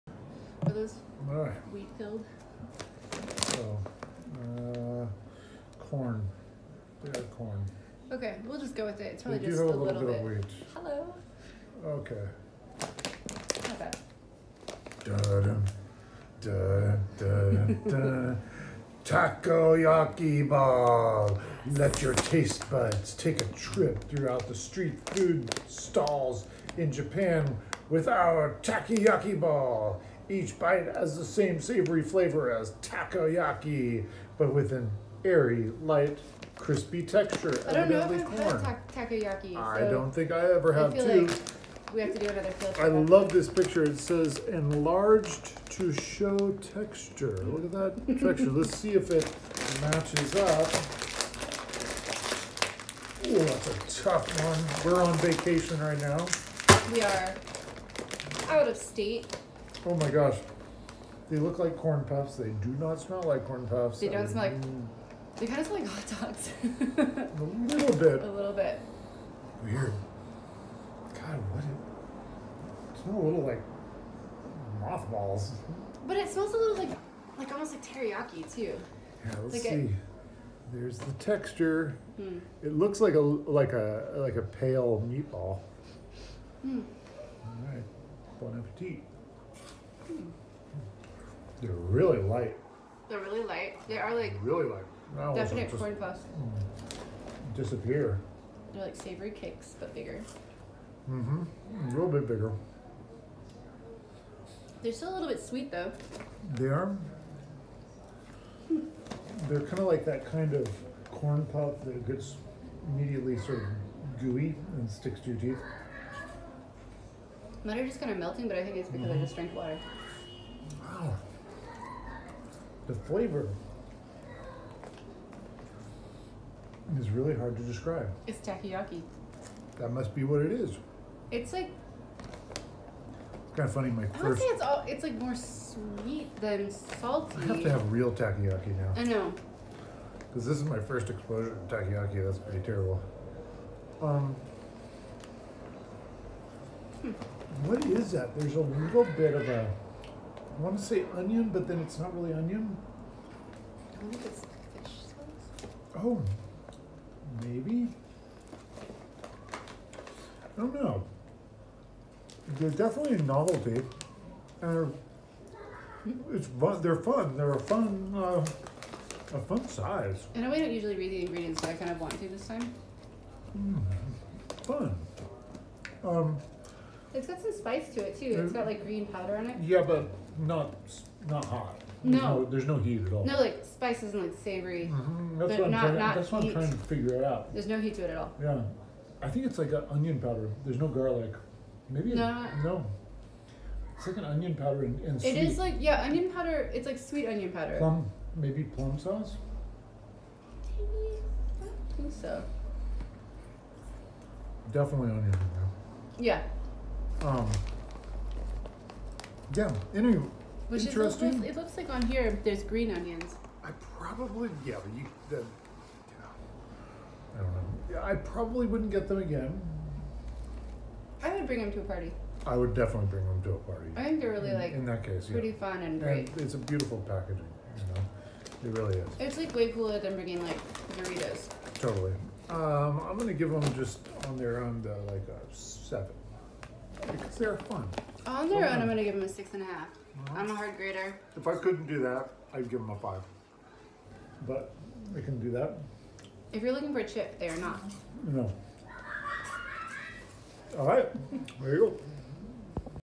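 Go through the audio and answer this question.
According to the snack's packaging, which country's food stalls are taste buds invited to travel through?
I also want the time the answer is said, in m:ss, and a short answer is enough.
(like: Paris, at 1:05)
Japan, at 0:26.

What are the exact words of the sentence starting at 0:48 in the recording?
Let's see if it matches up.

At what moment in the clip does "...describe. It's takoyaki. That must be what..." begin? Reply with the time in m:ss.
2:07.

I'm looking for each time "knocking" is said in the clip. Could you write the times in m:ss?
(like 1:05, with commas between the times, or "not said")
not said.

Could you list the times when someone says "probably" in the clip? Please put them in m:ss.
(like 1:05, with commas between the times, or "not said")
0:09, 3:33, 3:38.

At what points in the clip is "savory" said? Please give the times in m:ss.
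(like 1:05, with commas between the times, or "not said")
0:31, 1:38, 3:04.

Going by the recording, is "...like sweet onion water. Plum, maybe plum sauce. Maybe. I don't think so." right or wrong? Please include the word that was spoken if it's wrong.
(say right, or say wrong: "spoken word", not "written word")
wrong: "powder", not "water".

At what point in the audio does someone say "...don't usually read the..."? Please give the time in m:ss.
2:50.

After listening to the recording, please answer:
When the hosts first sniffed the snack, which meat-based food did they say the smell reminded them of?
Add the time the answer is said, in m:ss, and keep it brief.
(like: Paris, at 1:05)
hot dogs, at 1:05.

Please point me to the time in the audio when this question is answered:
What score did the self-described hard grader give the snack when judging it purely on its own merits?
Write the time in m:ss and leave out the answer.
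3:59.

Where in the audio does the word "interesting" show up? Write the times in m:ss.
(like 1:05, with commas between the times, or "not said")
3:30.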